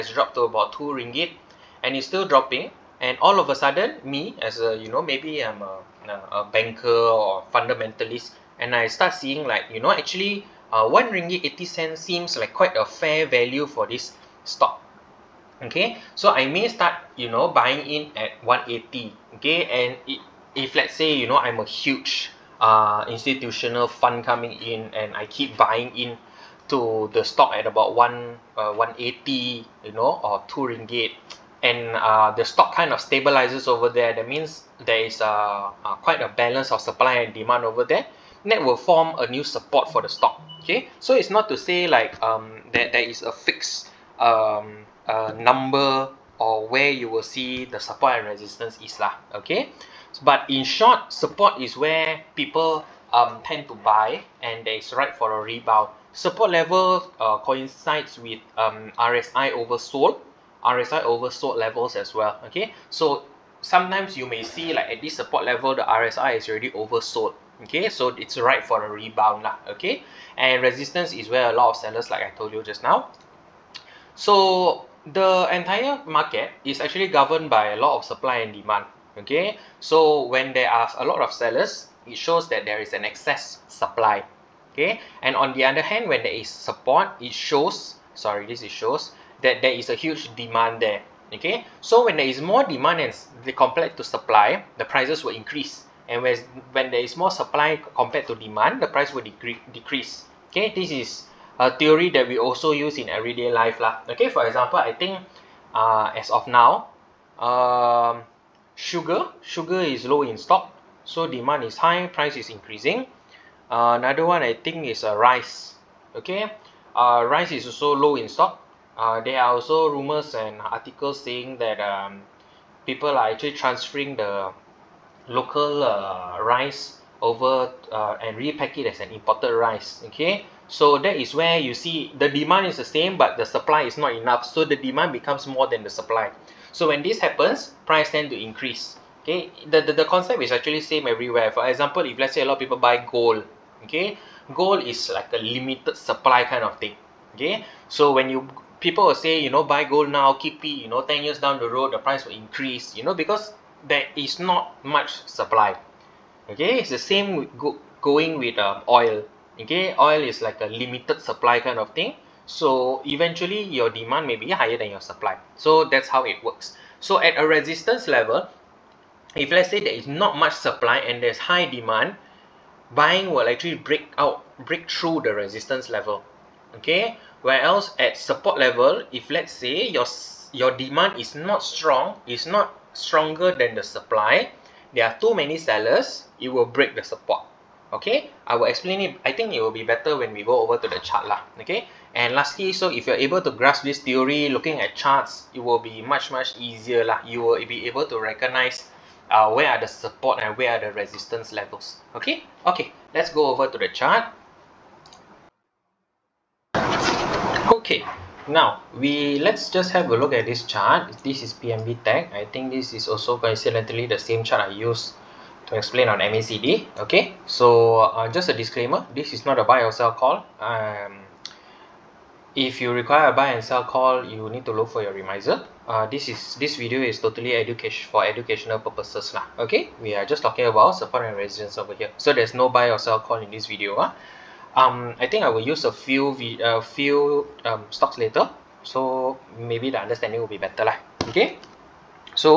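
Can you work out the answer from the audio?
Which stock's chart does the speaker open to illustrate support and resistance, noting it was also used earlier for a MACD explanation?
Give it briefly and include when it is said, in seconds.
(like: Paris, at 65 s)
PMB Tech, at 211 s.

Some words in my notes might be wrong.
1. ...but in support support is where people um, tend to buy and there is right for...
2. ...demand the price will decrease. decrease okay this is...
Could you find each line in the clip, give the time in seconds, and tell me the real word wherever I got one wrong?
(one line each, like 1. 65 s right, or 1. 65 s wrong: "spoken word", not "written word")
1. 50 s wrong: "short", not "support"
2. 98 s right.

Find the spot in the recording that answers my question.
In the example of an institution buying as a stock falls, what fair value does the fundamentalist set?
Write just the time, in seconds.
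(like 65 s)
10 s.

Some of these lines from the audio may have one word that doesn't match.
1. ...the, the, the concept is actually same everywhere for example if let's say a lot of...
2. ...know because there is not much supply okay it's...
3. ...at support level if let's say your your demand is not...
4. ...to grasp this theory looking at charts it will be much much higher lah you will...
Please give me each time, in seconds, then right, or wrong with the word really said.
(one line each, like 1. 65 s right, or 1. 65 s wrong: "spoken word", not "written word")
1. 139 s right
2. 153 s right
3. 178 s right
4. 193 s wrong: "easier", not "higher".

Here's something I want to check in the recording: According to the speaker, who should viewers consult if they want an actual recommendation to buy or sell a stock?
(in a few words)
remisier.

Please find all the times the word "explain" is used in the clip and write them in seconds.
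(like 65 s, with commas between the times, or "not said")
188 s, 215 s.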